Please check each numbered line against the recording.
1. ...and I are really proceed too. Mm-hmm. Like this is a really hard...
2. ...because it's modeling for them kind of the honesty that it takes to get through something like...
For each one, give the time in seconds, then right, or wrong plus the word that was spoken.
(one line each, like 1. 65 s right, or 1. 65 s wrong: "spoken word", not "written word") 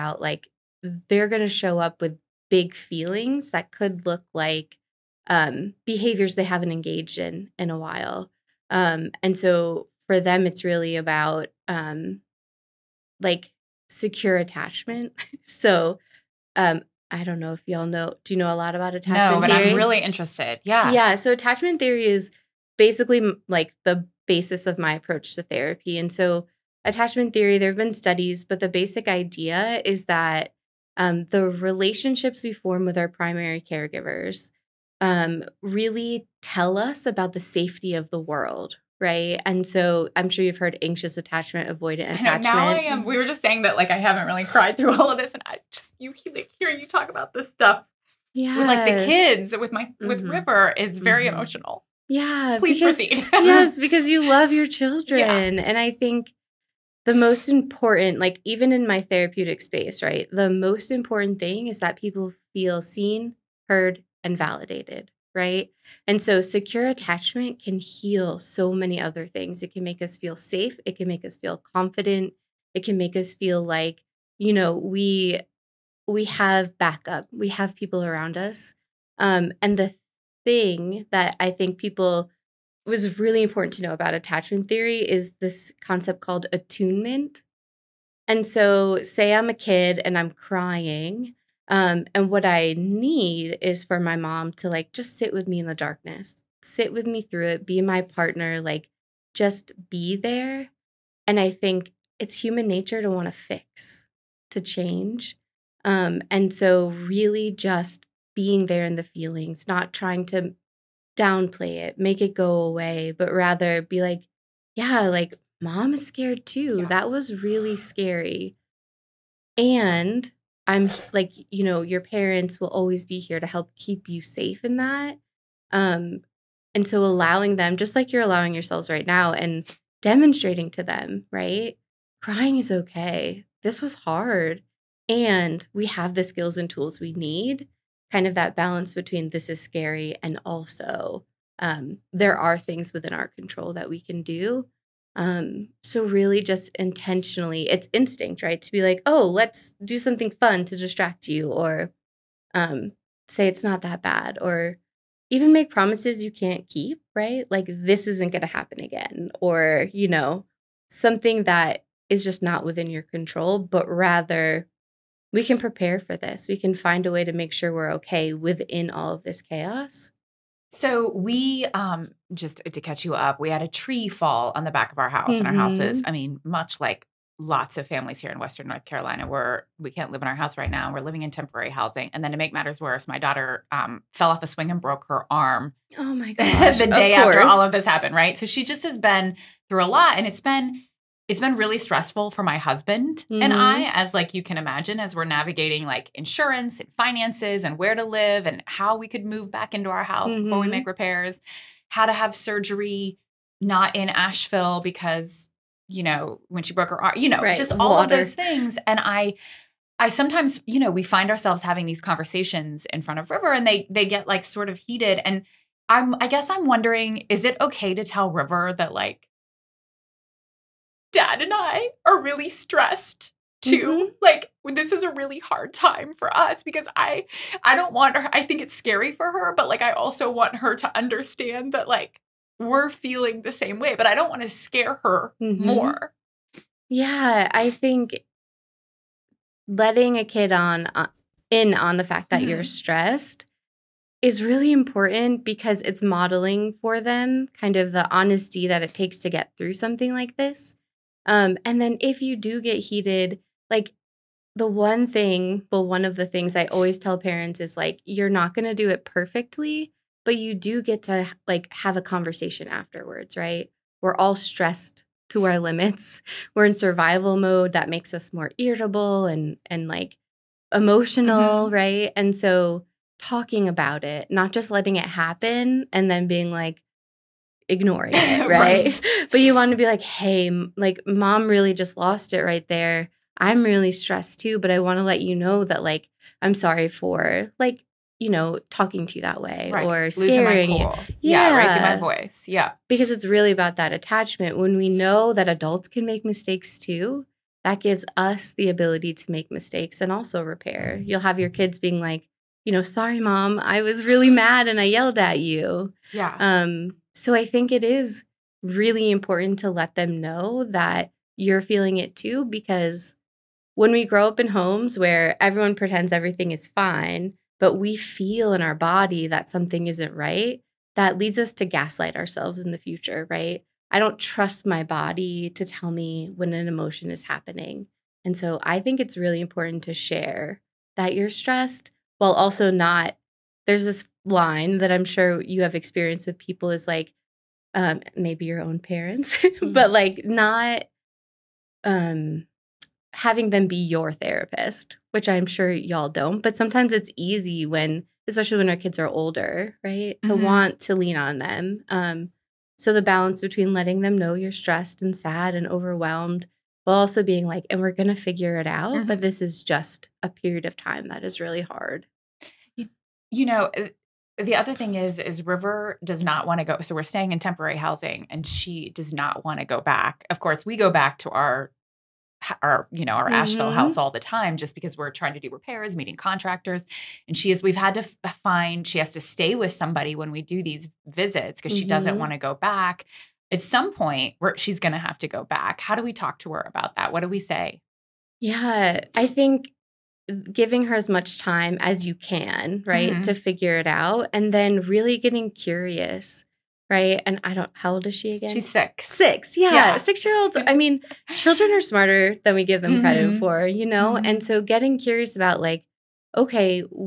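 1. 221 s wrong: "stressed", not "proceed"
2. 245 s right.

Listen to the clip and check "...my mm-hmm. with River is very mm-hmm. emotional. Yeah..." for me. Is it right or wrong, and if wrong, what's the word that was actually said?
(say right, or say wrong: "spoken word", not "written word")
right.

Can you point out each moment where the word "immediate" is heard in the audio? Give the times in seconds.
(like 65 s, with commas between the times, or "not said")
not said.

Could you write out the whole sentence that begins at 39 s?
And so I'm sure you've heard anxious attachment, avoidant attachment.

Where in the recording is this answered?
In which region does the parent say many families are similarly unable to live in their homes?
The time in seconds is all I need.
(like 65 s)
178 s.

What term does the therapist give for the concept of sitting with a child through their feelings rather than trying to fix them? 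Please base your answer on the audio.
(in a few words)
Attunement.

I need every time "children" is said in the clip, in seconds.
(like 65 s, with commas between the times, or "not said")
54 s, 401 s.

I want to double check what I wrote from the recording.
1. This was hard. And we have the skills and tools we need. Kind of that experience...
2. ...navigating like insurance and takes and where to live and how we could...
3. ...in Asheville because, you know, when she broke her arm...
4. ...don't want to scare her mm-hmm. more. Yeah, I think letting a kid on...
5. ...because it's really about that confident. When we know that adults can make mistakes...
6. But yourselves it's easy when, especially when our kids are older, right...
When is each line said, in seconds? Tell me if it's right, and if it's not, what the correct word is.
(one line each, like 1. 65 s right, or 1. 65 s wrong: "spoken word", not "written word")
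1. 133 s wrong: "balance", not "experience"
2. 195 s wrong: "finances", not "takes"
3. 203 s right
4. 234 s right
5. 292 s wrong: "attachment", not "confident"
6. 346 s wrong: "sometimes", not "yourselves".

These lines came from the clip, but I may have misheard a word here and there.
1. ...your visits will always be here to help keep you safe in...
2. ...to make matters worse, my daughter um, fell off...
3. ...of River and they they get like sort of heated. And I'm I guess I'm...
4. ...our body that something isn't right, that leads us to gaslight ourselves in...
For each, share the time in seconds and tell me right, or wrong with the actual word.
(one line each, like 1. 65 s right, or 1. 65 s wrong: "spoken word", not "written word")
1. 121 s wrong: "parents", not "visits"
2. 182 s right
3. 213 s right
4. 318 s right.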